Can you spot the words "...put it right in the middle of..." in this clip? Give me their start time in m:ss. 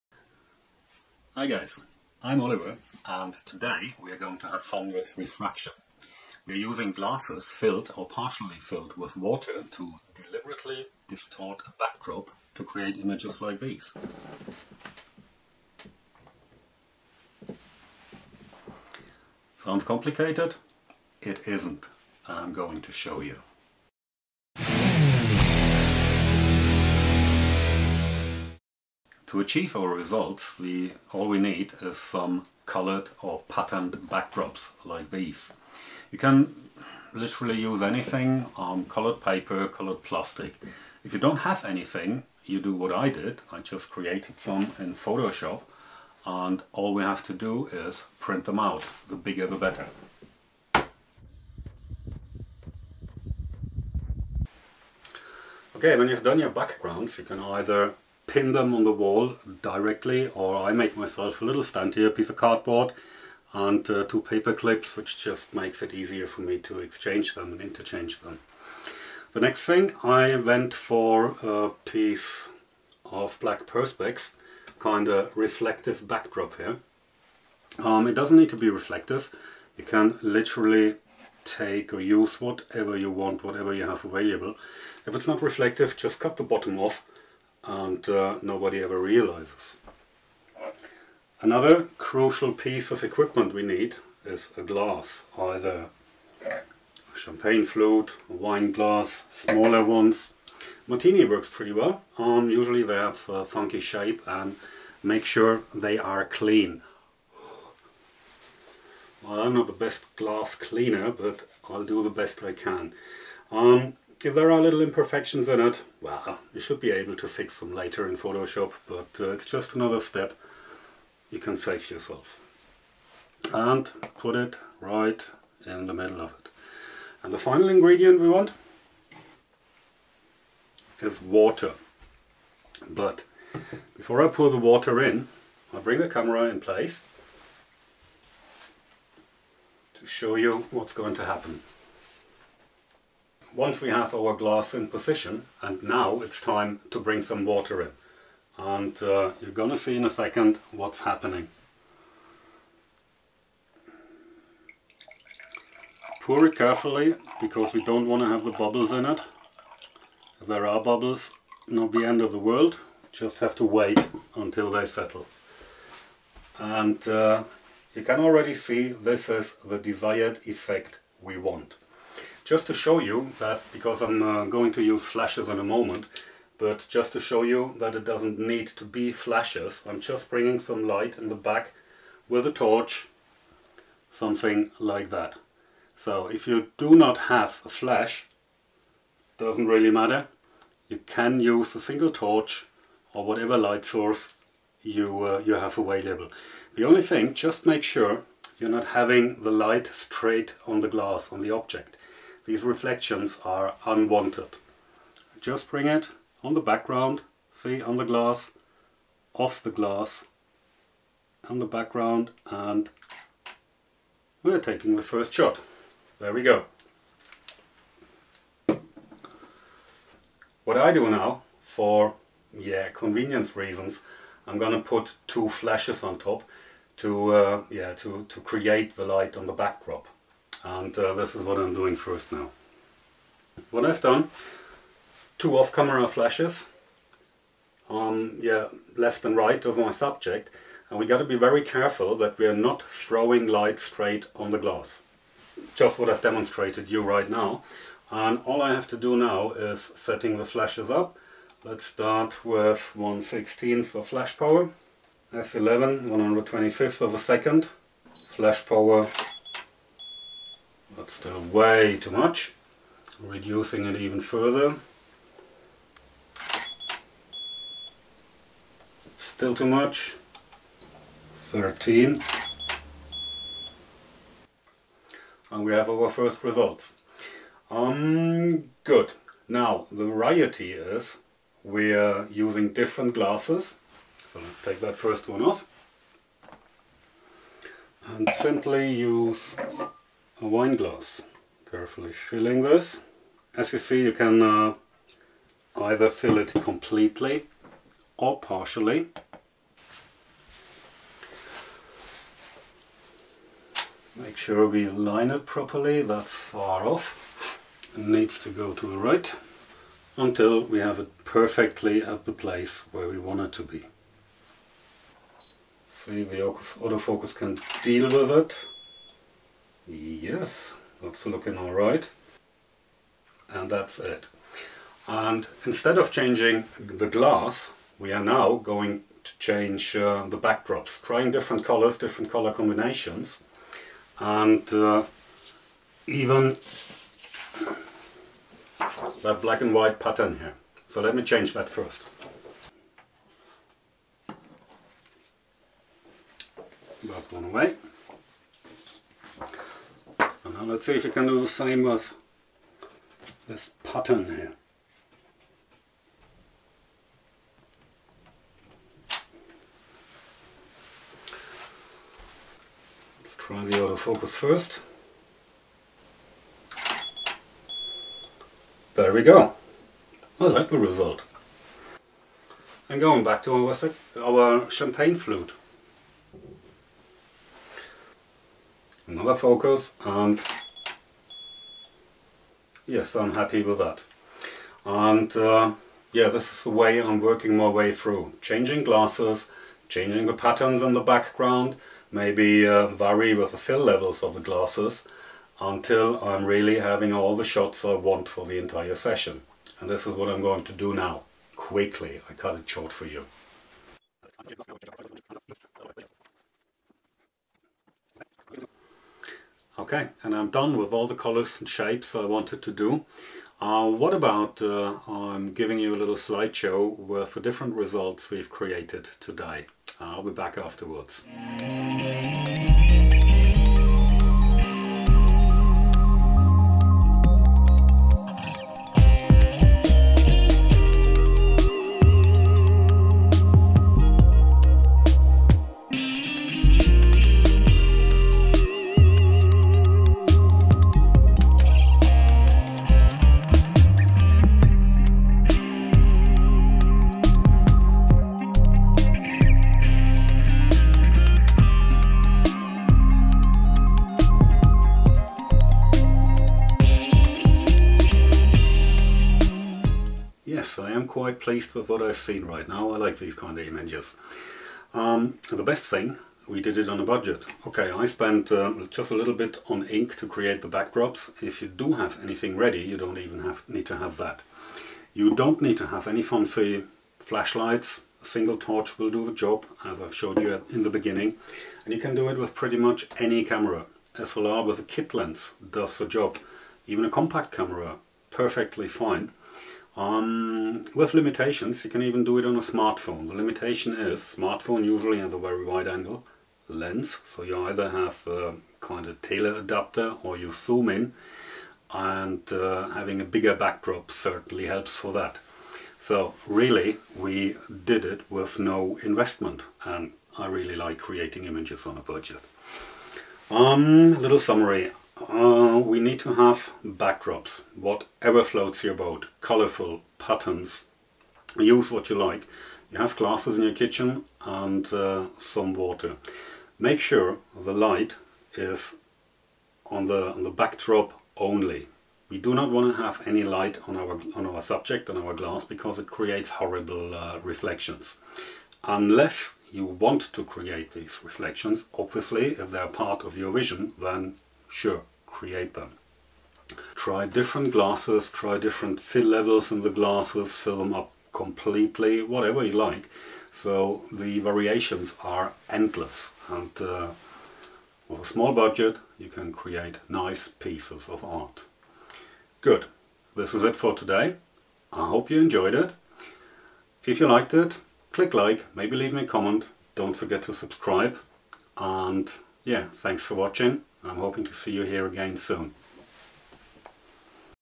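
2:04.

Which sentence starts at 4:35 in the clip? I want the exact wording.
And we have our first results.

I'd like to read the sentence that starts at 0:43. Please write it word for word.
I just created some in Photoshop and all we have to do is print them out.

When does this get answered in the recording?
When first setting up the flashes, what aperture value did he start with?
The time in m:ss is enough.
4:15.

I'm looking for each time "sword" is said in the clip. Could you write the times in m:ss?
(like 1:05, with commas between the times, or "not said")
not said.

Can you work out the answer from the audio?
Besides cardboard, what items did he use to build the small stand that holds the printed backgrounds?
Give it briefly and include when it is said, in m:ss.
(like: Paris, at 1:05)
two paper clips, at 1:04.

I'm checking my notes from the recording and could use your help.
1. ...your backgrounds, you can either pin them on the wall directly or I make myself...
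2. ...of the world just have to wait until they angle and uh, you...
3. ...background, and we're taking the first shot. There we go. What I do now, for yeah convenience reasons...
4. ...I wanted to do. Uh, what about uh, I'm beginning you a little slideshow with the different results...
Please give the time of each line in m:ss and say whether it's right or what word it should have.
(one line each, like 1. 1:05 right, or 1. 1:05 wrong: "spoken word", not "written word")
1. 0:56 right
2. 2:42 wrong: "settle", not "angle"
3. 3:31 right
4. 6:52 wrong: "giving", not "beginning".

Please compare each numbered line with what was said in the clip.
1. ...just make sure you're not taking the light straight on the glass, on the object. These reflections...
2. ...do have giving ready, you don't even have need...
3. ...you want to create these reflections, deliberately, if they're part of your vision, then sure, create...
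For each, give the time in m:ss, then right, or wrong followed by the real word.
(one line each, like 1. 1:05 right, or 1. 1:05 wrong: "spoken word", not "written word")
1. 3:17 wrong: "having", not "taking"
2. 7:51 wrong: "anything", not "giving"
3. 8:59 wrong: "obviously", not "deliberately".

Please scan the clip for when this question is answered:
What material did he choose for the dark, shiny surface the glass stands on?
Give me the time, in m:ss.
1:13.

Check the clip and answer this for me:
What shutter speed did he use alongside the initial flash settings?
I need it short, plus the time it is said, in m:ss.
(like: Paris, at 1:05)
1/125 second, at 4:16.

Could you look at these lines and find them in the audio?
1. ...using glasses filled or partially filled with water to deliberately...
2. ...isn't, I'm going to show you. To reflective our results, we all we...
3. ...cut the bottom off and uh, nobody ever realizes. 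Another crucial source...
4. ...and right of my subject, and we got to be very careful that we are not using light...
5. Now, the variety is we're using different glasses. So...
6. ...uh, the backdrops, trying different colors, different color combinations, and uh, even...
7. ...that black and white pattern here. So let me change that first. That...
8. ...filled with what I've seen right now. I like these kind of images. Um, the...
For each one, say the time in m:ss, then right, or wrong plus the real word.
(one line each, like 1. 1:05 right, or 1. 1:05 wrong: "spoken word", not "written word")
1. 0:06 right
2. 0:21 wrong: "achieve", not "reflective"
3. 1:26 wrong: "piece", not "source"
4. 3:59 wrong: "throwing", not "using"
5. 4:39 right
6. 5:29 right
7. 5:39 right
8. 7:41 wrong: "pleased", not "filled".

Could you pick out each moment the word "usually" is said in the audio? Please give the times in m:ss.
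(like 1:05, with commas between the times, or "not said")
1:42, 8:14.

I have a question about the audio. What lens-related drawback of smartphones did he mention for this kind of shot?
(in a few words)
very wide angle lens.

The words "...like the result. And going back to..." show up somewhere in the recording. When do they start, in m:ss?
6:10.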